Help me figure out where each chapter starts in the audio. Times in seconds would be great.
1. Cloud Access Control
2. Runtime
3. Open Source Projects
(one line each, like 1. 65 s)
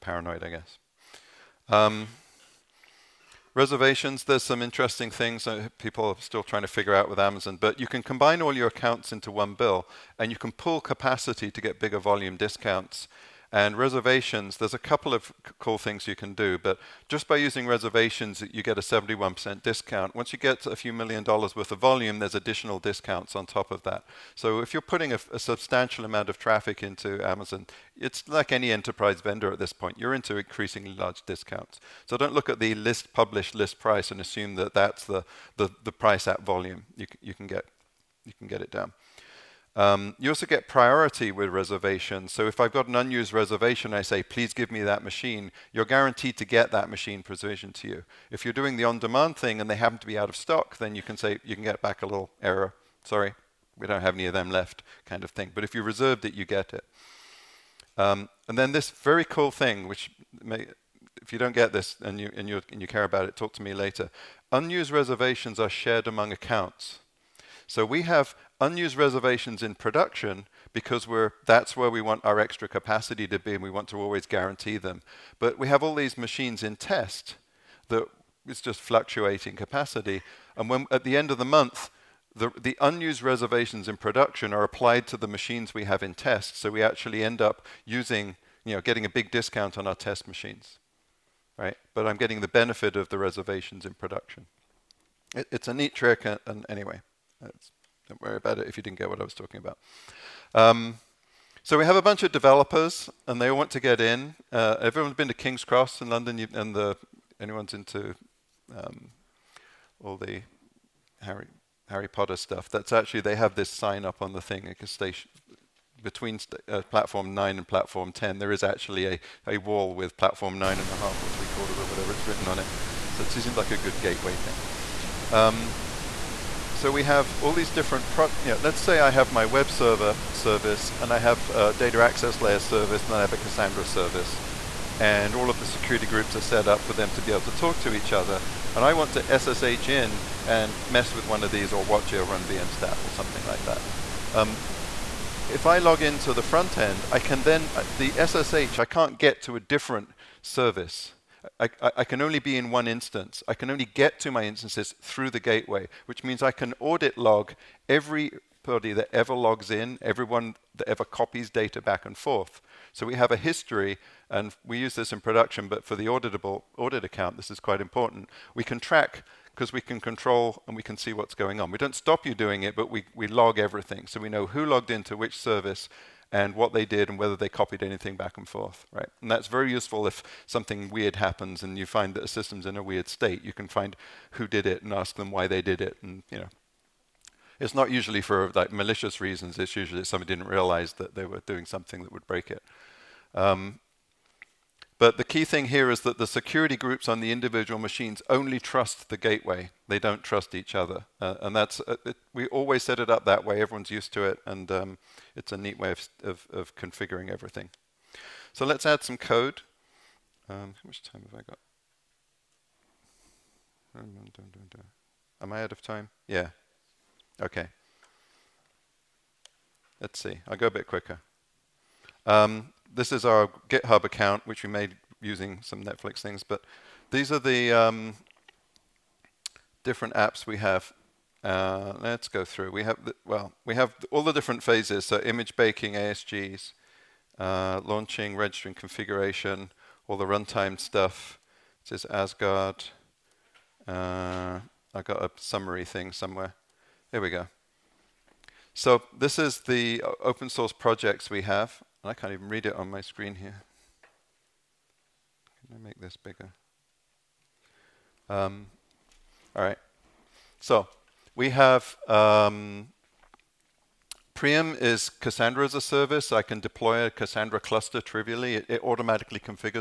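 1. 103 s
2. 237 s
3. 251 s.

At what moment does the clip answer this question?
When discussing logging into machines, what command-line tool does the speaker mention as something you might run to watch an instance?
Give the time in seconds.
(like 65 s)
142 s.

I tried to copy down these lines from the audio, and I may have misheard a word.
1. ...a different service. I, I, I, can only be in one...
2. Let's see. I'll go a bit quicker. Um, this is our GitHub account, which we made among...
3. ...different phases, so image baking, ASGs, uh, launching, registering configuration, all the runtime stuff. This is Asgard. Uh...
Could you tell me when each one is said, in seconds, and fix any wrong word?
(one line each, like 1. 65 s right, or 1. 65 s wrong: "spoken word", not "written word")
1. 149 s right
2. 220 s wrong: "using", not "among"
3. 234 s right.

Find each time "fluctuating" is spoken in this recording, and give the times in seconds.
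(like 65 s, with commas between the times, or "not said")
78 s.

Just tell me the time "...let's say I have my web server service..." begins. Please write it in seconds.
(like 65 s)
128 s.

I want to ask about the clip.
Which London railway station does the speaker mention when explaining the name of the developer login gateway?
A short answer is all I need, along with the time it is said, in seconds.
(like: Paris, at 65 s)
King's Cross, at 105 s.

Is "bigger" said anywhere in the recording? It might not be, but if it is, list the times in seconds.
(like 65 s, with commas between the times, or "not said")
11 s, 256 s.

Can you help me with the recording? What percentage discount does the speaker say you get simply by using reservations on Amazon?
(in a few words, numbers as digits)
71%.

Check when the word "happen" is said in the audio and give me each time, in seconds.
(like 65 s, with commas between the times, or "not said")
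49 s, 181 s.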